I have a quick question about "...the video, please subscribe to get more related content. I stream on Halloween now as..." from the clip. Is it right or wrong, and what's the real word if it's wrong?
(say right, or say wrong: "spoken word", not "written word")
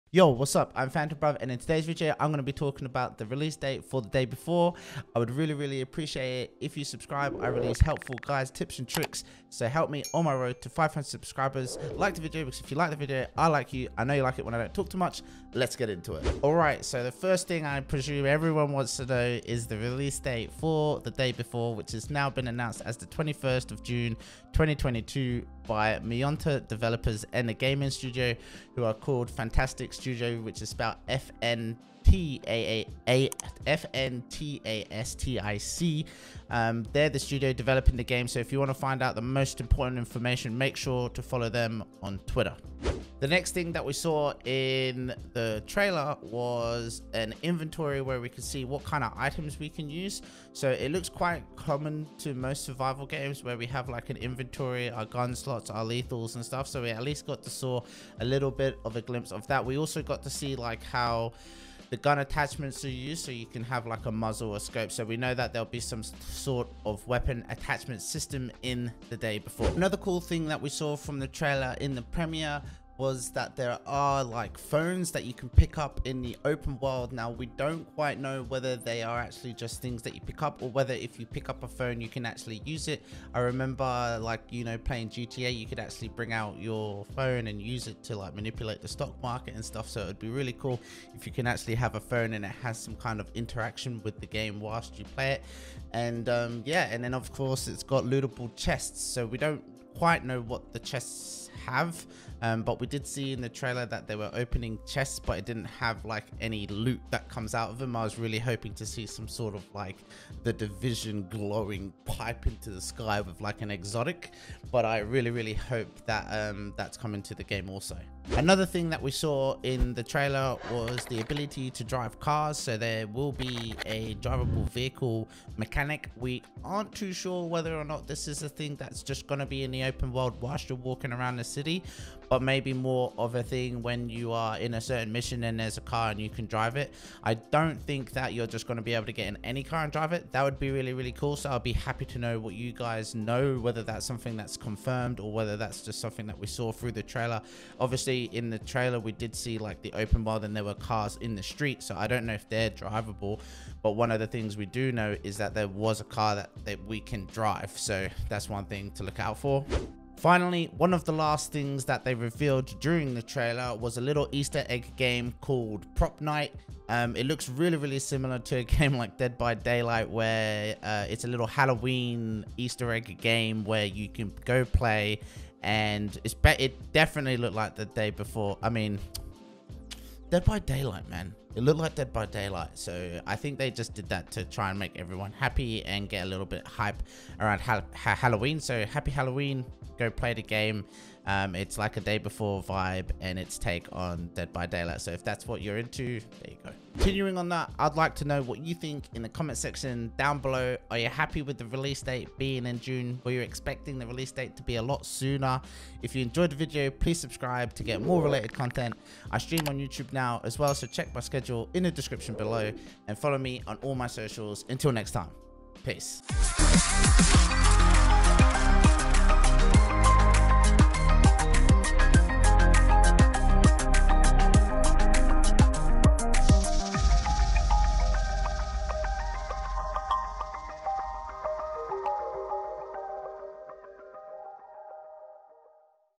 wrong: "YouTube", not "Halloween".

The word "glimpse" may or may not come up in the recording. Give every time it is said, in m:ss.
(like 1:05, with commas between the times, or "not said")
0:59.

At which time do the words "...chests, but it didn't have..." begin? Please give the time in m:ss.
1:44.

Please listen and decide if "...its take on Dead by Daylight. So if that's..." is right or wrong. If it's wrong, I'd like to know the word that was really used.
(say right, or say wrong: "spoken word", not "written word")
right.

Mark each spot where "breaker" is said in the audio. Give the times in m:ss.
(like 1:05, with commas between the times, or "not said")
not said.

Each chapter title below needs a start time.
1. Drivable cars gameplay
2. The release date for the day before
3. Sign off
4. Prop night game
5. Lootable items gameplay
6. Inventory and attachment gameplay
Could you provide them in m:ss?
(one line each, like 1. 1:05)
1. 1:58
2. 0:16
3. 3:17
4. 2:40
5. 1:10
6. 0:42.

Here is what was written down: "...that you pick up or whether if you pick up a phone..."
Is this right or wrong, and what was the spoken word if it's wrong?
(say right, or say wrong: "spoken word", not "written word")
right.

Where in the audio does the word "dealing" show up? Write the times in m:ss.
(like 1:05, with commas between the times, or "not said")
not said.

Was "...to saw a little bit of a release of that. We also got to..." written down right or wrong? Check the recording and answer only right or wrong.
wrong.